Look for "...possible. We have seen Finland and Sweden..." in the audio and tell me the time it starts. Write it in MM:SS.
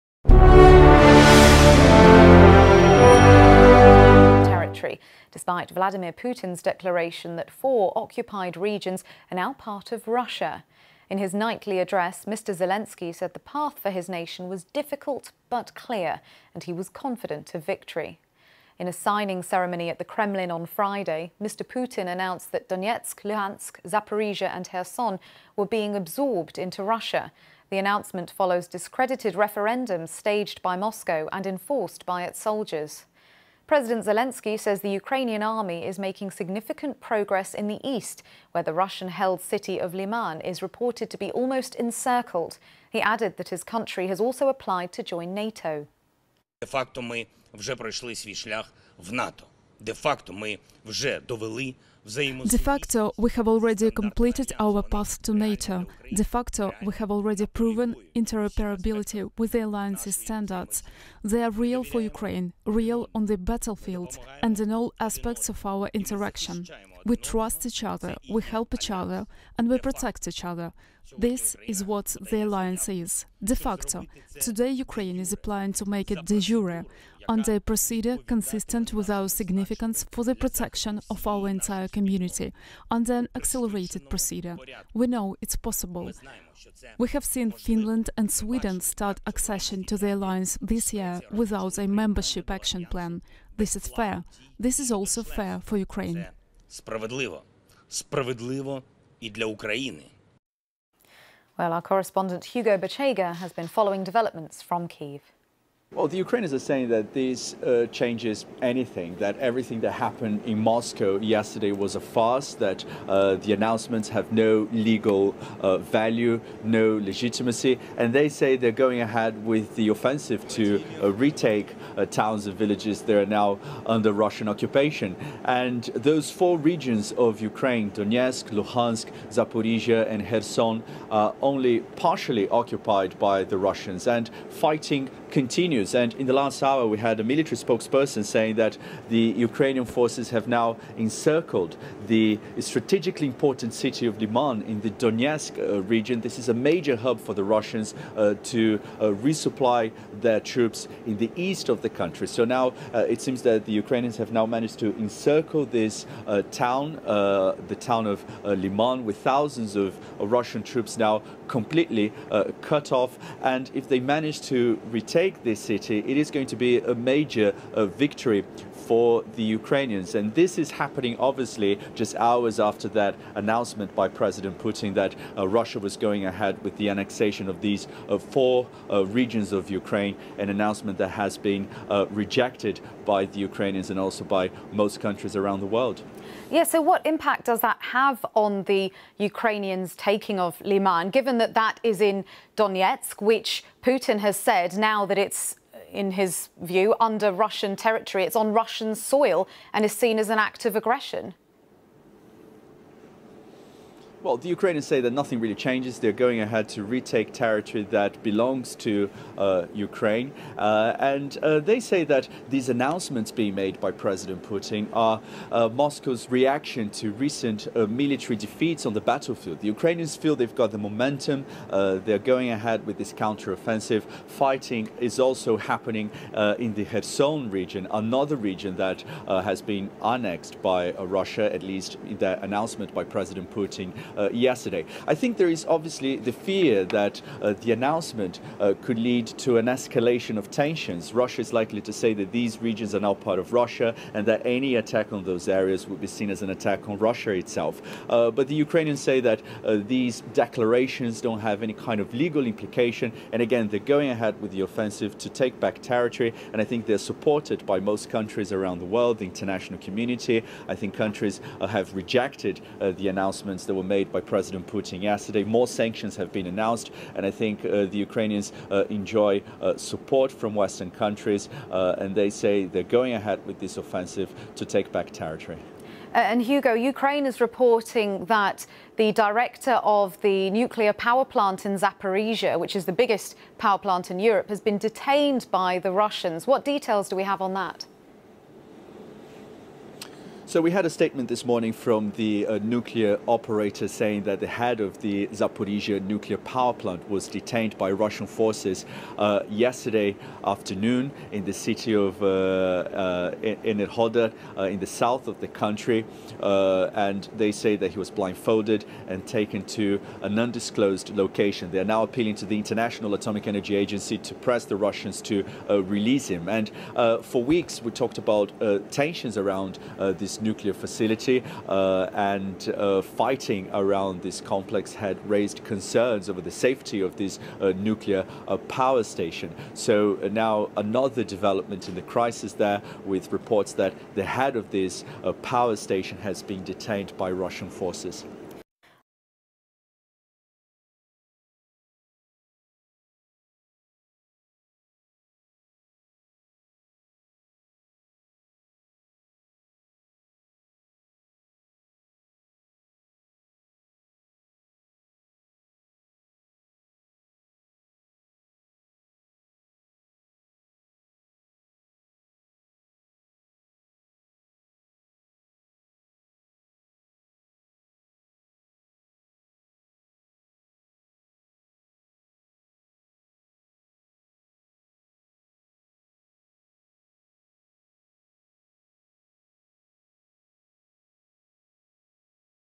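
01:25.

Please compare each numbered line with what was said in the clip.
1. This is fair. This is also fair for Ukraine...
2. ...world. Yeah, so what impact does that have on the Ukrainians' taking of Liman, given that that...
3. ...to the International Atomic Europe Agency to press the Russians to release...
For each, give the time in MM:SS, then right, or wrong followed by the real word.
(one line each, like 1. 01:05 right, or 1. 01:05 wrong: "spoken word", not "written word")
1. 01:33 right
2. 03:05 right
3. 05:12 wrong: "Energy", not "Europe".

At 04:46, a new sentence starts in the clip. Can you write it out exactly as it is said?
What details do we have on that?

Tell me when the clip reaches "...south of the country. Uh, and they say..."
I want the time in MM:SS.
05:04.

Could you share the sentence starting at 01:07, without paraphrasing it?
We trust each other, we help each other, and we protect each other.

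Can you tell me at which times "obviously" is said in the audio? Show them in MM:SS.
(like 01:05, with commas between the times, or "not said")
02:51, 03:55.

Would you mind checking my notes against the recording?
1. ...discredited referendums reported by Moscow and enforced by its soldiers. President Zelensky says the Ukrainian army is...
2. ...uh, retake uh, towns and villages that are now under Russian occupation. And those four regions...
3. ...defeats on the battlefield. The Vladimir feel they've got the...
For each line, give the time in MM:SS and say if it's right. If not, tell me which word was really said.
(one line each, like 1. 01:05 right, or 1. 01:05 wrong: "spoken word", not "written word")
1. 00:28 wrong: "staged", not "reported"
2. 02:01 right
3. 03:38 wrong: "Ukrainians", not "Vladimir".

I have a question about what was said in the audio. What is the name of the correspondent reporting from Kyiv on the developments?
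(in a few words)
Hugo Bachega.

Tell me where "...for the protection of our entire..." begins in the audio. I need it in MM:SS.
01:20.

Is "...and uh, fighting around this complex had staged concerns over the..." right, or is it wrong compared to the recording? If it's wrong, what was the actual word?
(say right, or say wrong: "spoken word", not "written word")
wrong: "raised", not "staged".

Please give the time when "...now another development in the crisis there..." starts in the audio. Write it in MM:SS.
05:30.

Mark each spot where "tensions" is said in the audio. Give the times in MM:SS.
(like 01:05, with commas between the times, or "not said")
04:00, 05:18.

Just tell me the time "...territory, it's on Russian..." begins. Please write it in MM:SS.
03:17.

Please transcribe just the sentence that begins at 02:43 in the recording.
And if they manage to retain take this city, it is going to be a major uh, victory for the Ukrainians.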